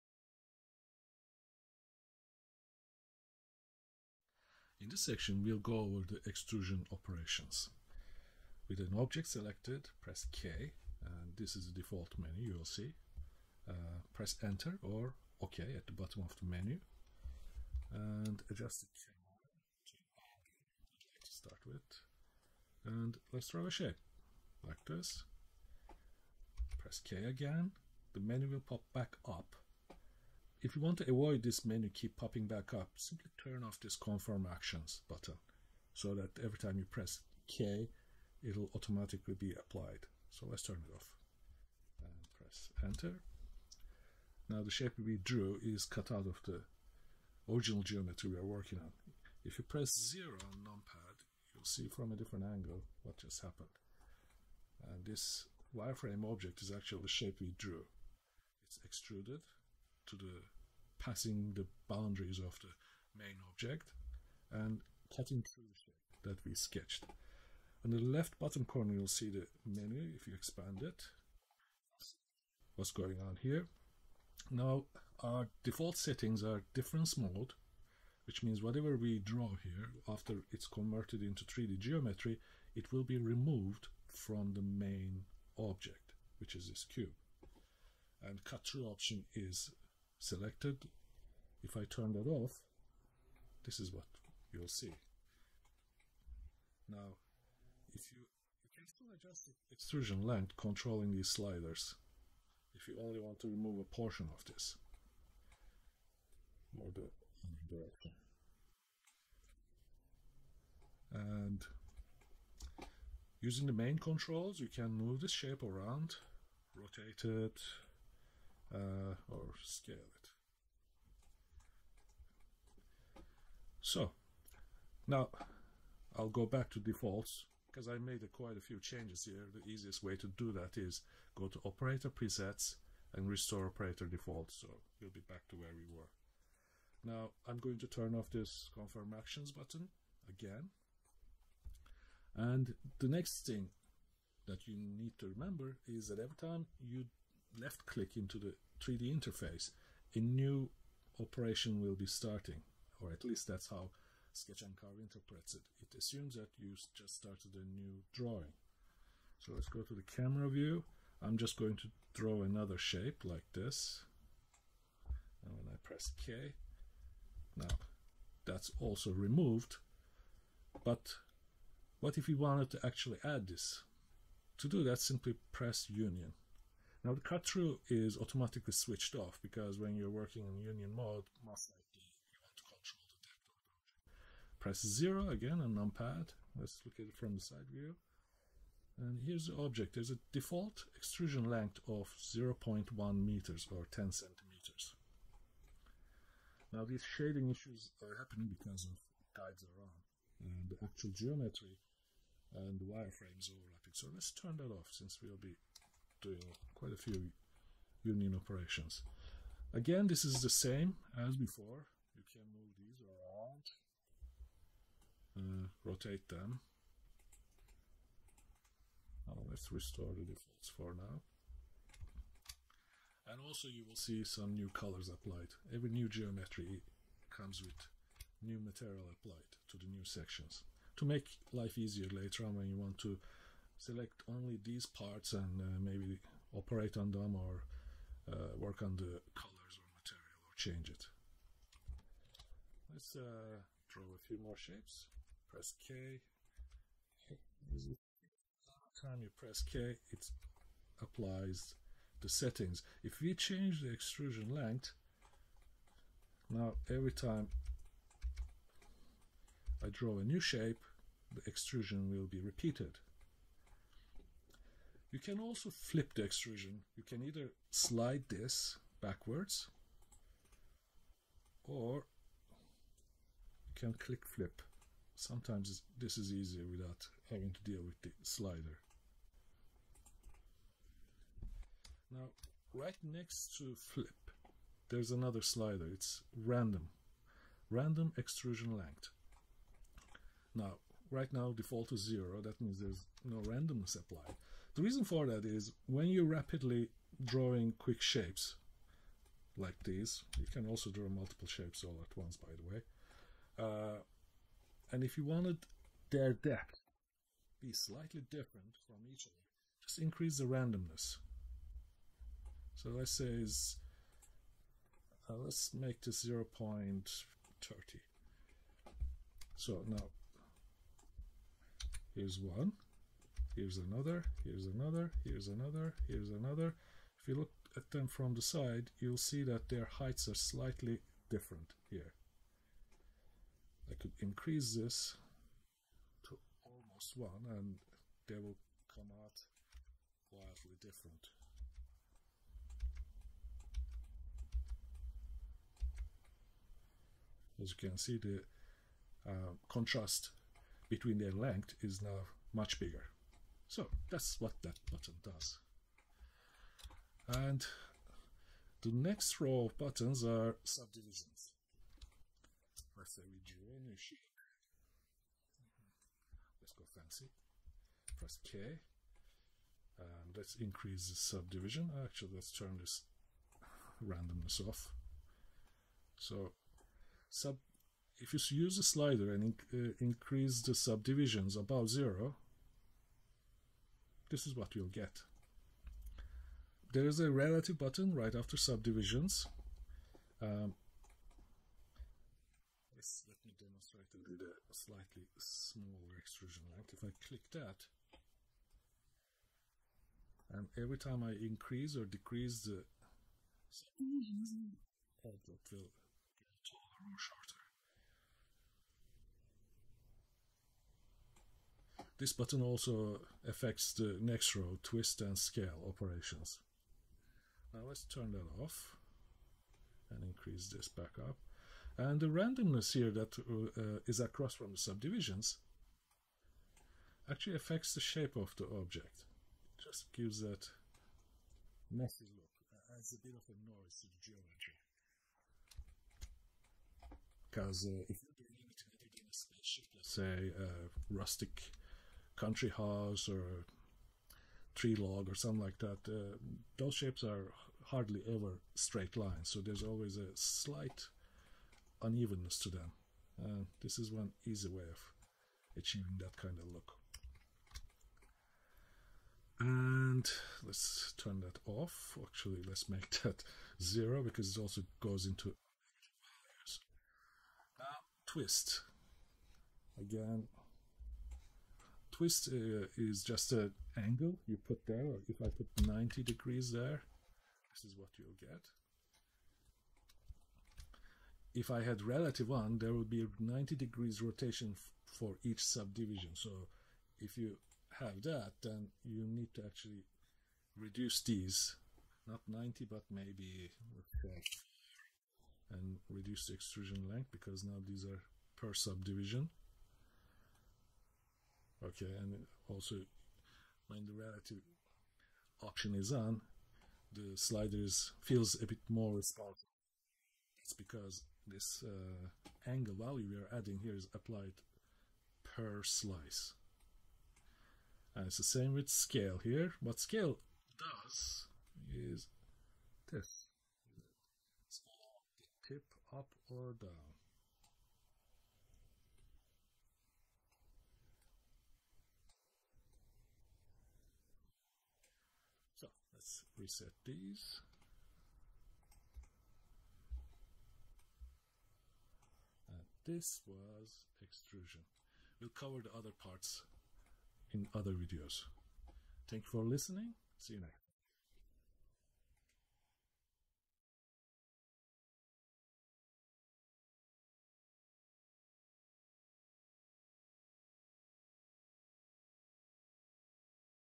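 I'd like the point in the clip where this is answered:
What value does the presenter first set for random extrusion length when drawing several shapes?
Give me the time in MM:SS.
05:16.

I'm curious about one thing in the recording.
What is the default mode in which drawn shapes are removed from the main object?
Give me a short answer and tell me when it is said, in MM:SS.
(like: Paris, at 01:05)
difference mode, at 01:16.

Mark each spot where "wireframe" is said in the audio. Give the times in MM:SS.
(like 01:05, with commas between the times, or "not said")
00:55, 03:22.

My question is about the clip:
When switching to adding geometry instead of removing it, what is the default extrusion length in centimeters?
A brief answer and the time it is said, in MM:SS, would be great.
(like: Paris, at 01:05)
10 centimeters, at 03:13.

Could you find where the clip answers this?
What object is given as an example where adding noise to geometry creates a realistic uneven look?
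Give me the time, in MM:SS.
07:24.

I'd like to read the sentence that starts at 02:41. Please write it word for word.
I'm just going to draw another shape like this.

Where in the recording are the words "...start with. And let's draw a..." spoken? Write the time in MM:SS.
00:21.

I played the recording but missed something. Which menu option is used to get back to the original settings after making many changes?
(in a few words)
restore operator defaults.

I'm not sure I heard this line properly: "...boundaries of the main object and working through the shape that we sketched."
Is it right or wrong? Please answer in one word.
wrong.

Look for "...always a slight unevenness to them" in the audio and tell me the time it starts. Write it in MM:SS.
07:29.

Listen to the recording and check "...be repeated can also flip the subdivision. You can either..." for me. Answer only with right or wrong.
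wrong.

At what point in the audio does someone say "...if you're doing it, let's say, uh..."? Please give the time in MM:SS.
07:18.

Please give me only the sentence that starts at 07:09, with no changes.
It just gives that messy look, uh, adds a bit of a noise to the geometry.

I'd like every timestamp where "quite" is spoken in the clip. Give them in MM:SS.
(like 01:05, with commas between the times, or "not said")
02:08, 03:26.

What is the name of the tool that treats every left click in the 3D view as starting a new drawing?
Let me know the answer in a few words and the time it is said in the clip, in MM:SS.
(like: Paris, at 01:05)
SketchN'Carve, at 02:34.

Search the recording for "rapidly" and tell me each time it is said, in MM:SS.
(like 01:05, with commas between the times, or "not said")
04:56.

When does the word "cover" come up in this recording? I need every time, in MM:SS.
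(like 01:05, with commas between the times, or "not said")
09:05.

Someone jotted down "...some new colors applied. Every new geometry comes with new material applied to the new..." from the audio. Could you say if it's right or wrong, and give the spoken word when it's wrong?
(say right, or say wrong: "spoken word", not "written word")
right.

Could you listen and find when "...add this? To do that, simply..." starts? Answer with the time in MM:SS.
02:53.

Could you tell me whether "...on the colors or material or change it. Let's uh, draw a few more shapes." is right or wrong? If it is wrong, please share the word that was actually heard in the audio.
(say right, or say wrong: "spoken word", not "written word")
right.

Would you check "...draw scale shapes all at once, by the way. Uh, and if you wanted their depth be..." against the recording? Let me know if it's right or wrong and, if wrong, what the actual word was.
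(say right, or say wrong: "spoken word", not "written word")
wrong: "multiple", not "scale".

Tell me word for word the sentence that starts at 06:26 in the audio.
There is a relative button right after subdivisions.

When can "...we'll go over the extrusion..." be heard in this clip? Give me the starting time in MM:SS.
00:05.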